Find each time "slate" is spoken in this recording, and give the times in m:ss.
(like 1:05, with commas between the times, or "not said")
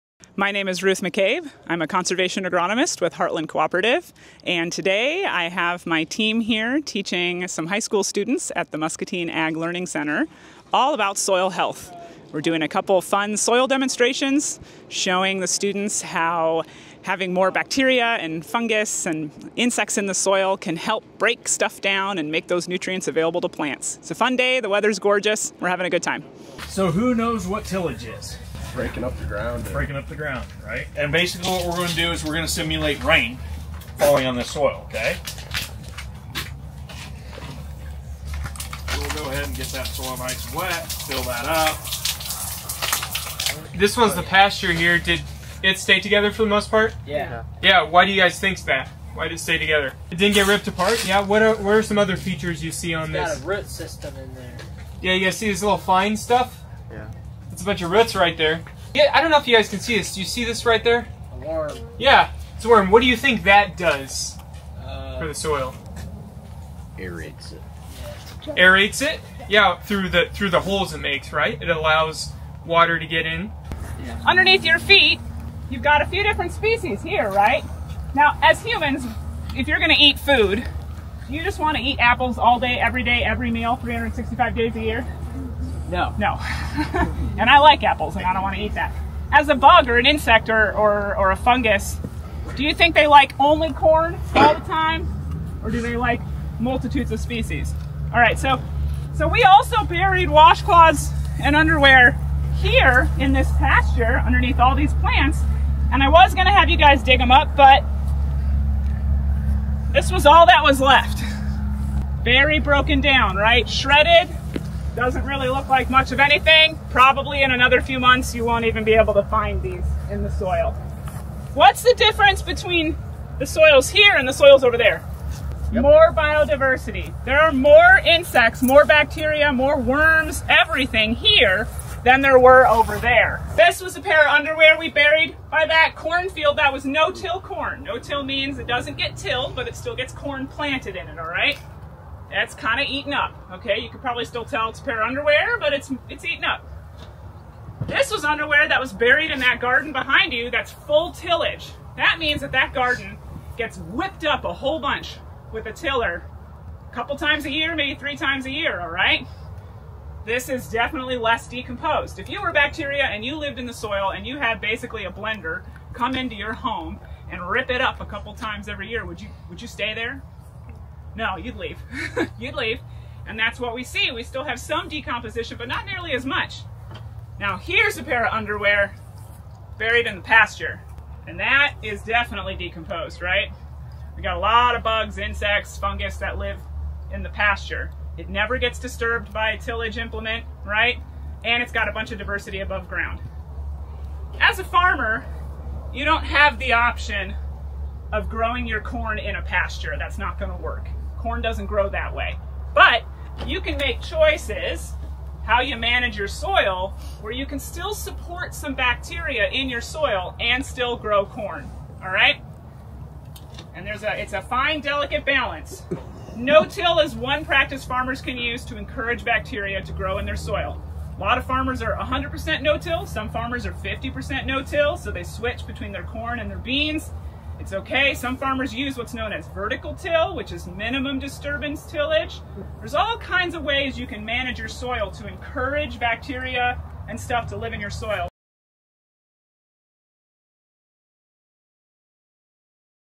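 not said.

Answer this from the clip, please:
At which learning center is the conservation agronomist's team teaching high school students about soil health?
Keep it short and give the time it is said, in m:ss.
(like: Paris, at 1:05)
Muscatine Ag Learning Center, at 0:08.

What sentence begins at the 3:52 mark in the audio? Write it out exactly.
There's all kinds of ways you can manage your soil to encourage bacteria and stuff to live in your soil.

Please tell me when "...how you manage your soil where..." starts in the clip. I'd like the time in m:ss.
3:25.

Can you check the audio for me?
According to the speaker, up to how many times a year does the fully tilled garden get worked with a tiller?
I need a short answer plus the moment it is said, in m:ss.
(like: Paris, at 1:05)
3 times, at 2:37.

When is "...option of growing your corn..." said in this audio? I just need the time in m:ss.
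3:16.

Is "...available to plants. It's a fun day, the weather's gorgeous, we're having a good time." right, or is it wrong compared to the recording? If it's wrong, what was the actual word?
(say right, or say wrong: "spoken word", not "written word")
right.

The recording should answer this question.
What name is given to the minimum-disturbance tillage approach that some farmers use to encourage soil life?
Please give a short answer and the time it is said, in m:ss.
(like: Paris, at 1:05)
Vertical till, at 3:49.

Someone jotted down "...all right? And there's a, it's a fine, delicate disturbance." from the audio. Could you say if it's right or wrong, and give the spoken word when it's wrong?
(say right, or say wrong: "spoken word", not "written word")
wrong: "balance", not "disturbance".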